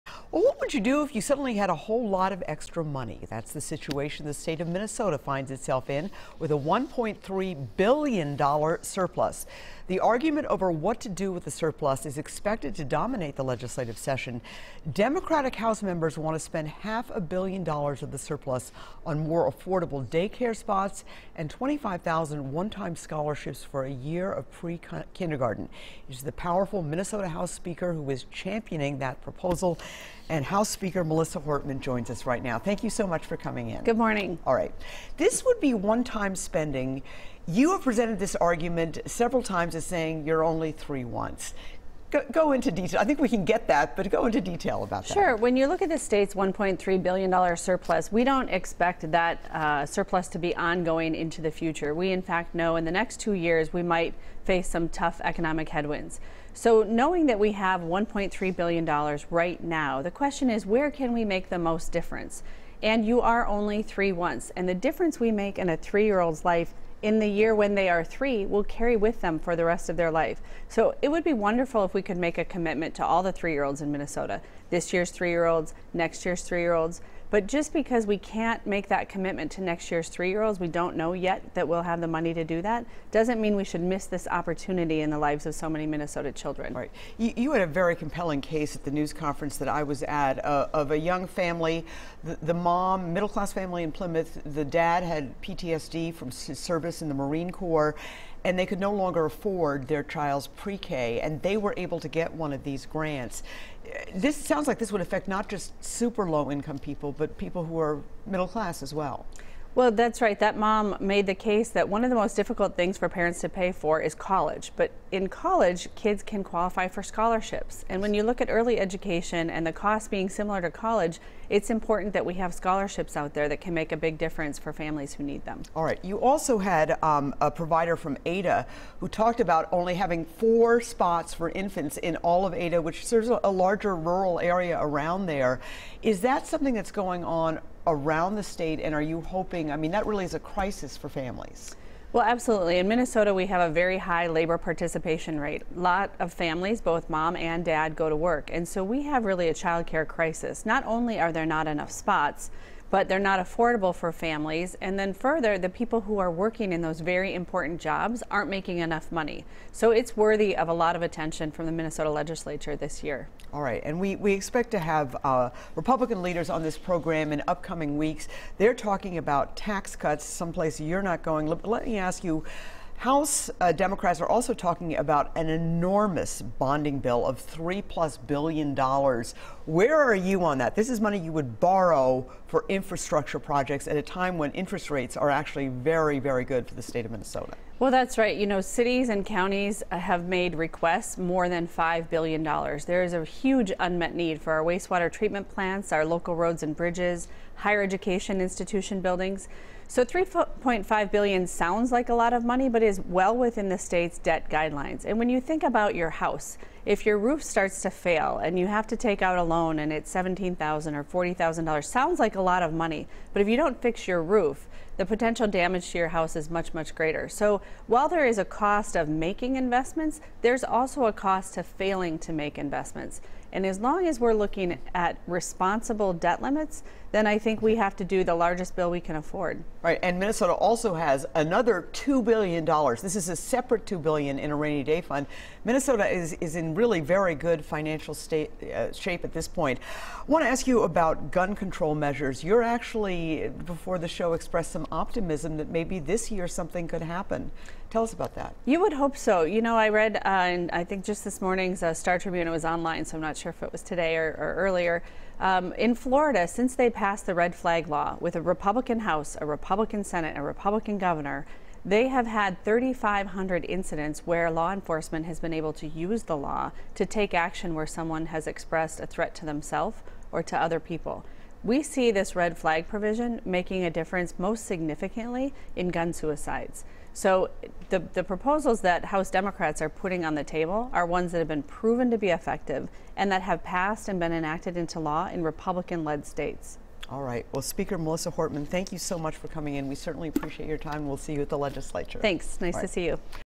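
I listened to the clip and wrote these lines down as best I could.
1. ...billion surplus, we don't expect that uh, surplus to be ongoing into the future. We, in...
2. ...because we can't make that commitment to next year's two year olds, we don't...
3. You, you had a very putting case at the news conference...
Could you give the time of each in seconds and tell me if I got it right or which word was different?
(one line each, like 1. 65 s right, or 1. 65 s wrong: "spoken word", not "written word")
1. 47 s right
2. 77 s wrong: "three", not "two"
3. 87 s wrong: "compelling", not "putting".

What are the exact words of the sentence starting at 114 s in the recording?
But in college, kids can qualify for scholarships.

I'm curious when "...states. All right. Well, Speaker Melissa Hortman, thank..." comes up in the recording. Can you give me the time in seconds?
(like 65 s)
286 s.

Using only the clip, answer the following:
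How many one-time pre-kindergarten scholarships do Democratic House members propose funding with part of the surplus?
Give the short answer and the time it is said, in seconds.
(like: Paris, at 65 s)
25,000, at 21 s.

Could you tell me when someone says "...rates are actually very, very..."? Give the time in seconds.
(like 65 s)
184 s.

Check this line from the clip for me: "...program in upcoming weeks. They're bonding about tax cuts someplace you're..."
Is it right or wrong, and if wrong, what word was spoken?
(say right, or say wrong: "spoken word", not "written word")
wrong: "talking", not "bonding".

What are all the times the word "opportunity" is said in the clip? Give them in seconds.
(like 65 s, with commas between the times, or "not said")
84 s.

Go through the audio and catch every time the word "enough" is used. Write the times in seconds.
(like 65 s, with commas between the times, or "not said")
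151 s, 158 s.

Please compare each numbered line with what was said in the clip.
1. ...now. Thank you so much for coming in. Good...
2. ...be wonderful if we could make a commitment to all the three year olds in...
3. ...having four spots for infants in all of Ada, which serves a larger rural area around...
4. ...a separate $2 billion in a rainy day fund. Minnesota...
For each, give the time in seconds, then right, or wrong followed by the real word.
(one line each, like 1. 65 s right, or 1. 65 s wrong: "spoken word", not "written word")
1. 32 s right
2. 71 s right
3. 129 s right
4. 233 s right.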